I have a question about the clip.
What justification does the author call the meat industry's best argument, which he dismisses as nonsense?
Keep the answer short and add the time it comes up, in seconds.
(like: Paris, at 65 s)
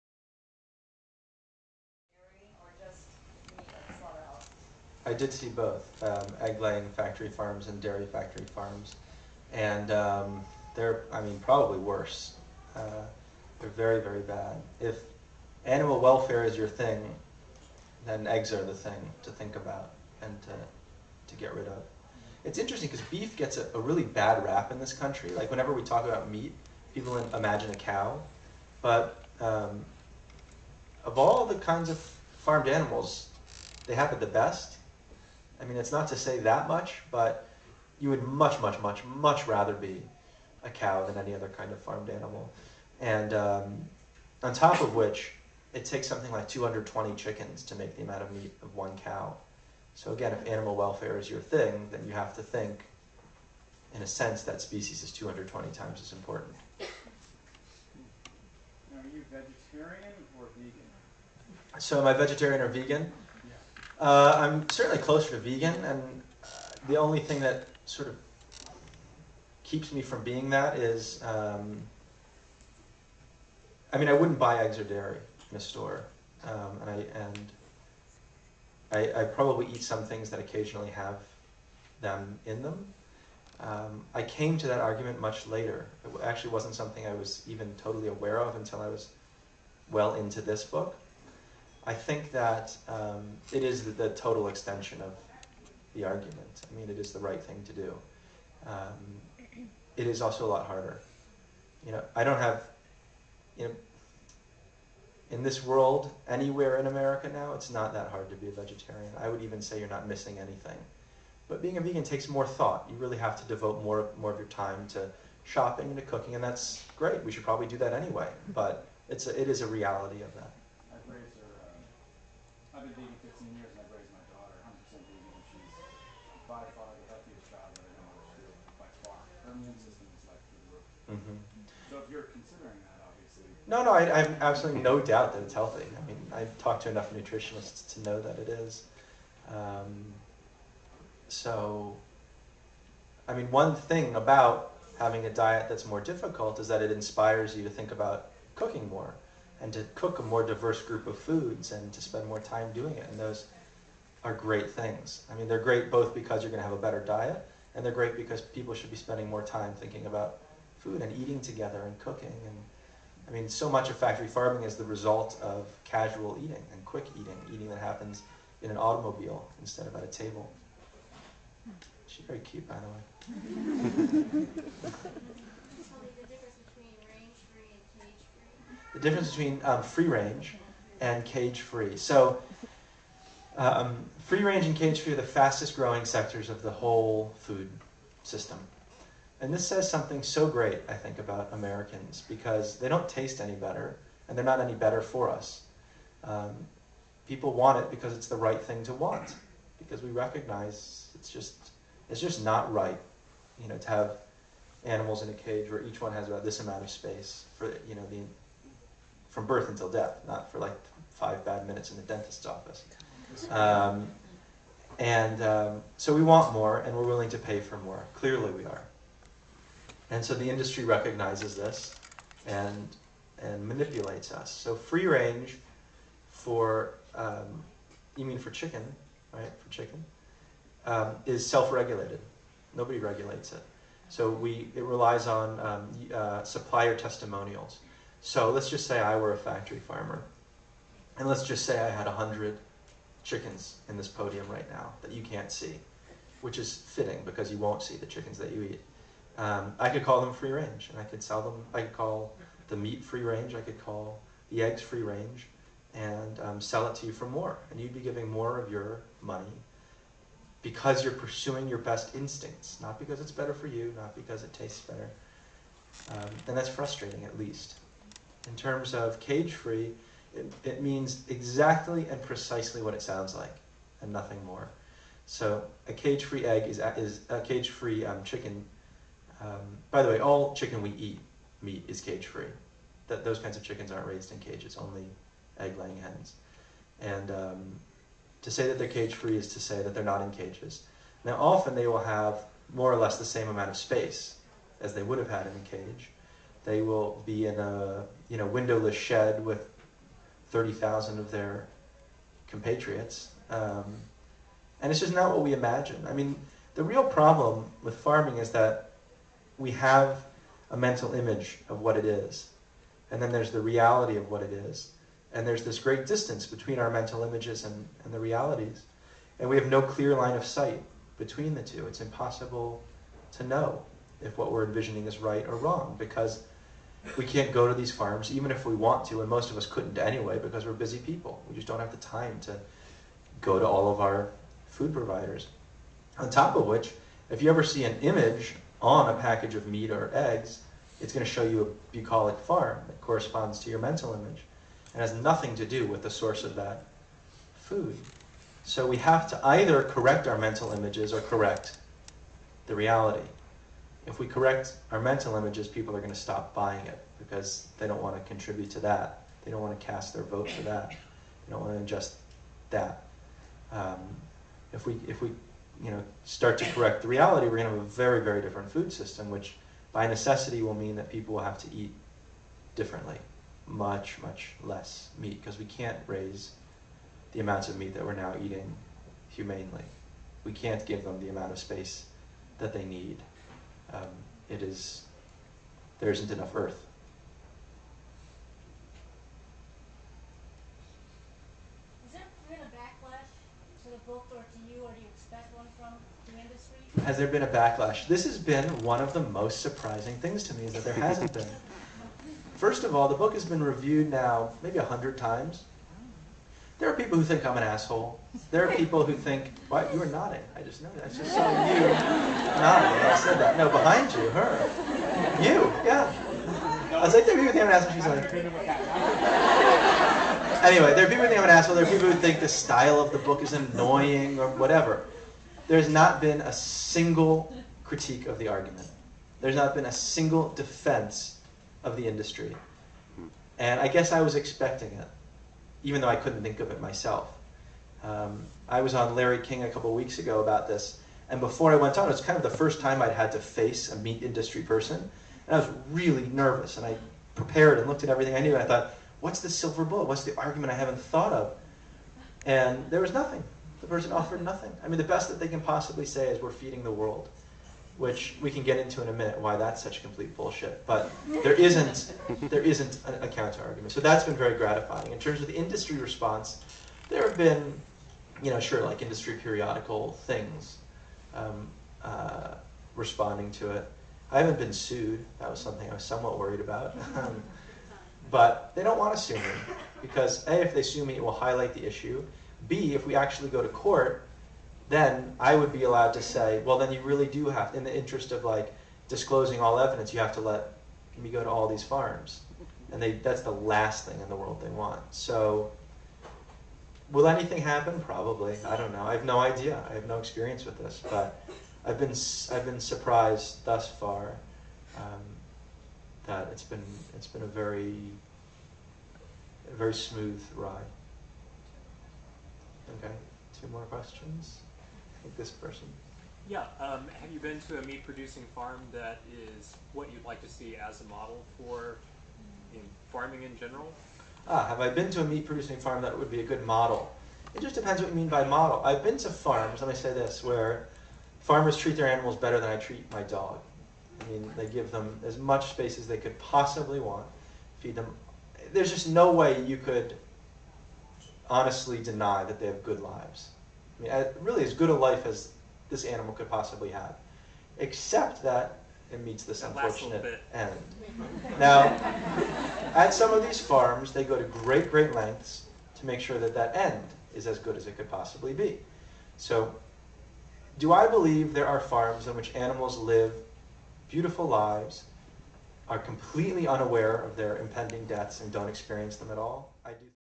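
feeding the world, at 456 s.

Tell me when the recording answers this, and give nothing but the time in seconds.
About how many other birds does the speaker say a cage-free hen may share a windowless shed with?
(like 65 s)
300 s.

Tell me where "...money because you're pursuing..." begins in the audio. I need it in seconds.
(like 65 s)
259 s.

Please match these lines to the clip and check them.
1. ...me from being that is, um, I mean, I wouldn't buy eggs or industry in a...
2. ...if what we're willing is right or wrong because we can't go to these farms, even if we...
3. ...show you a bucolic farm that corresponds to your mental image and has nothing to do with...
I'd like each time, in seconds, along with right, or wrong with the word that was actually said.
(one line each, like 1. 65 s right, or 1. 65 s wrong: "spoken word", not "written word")
1. 69 s wrong: "dairy", not "industry"
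2. 324 s wrong: "envisioning", not "willing"
3. 341 s right.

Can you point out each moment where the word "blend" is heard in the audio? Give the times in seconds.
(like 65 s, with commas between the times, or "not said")
not said.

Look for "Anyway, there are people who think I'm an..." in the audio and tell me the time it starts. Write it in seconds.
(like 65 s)
420 s.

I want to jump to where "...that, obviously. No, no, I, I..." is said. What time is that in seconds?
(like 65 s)
132 s.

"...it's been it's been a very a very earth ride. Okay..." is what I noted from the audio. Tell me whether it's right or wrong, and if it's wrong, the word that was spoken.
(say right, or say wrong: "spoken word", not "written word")
wrong: "smooth", not "earth".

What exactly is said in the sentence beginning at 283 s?
those kinds of chickens aren't raised in cages, only egg laying hens.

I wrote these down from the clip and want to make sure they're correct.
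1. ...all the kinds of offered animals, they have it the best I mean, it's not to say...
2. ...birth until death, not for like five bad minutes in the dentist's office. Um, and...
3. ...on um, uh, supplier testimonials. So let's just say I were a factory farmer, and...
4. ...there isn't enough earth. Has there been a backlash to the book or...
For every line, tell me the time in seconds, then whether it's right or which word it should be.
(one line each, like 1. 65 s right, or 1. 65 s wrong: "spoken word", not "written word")
1. 31 s wrong: "farmed", not "offered"
2. 209 s right
3. 235 s right
4. 385 s right.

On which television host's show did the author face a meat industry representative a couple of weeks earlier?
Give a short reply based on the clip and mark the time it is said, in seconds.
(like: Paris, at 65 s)
Larry King, at 439 s.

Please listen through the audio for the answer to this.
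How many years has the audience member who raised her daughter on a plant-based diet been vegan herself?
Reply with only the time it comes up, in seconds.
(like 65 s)
123 s.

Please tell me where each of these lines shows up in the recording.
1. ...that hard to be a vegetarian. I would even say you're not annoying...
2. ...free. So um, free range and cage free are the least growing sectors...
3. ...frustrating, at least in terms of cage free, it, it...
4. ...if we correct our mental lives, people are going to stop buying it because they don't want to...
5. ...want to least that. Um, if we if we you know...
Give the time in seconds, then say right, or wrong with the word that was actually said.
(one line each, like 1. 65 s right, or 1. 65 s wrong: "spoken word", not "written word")
1. 107 s wrong: "missing", not "annoying"
2. 181 s wrong: "fastest", not "least"
3. 266 s right
4. 354 s wrong: "images", not "lives"
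5. 361 s wrong: "adjust", not "least".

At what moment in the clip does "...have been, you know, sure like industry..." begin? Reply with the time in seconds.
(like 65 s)
467 s.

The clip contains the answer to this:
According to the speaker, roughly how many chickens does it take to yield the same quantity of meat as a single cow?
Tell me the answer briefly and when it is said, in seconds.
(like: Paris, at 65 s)
220, at 46 s.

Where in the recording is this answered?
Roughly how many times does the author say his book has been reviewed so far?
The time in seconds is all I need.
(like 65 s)
404 s.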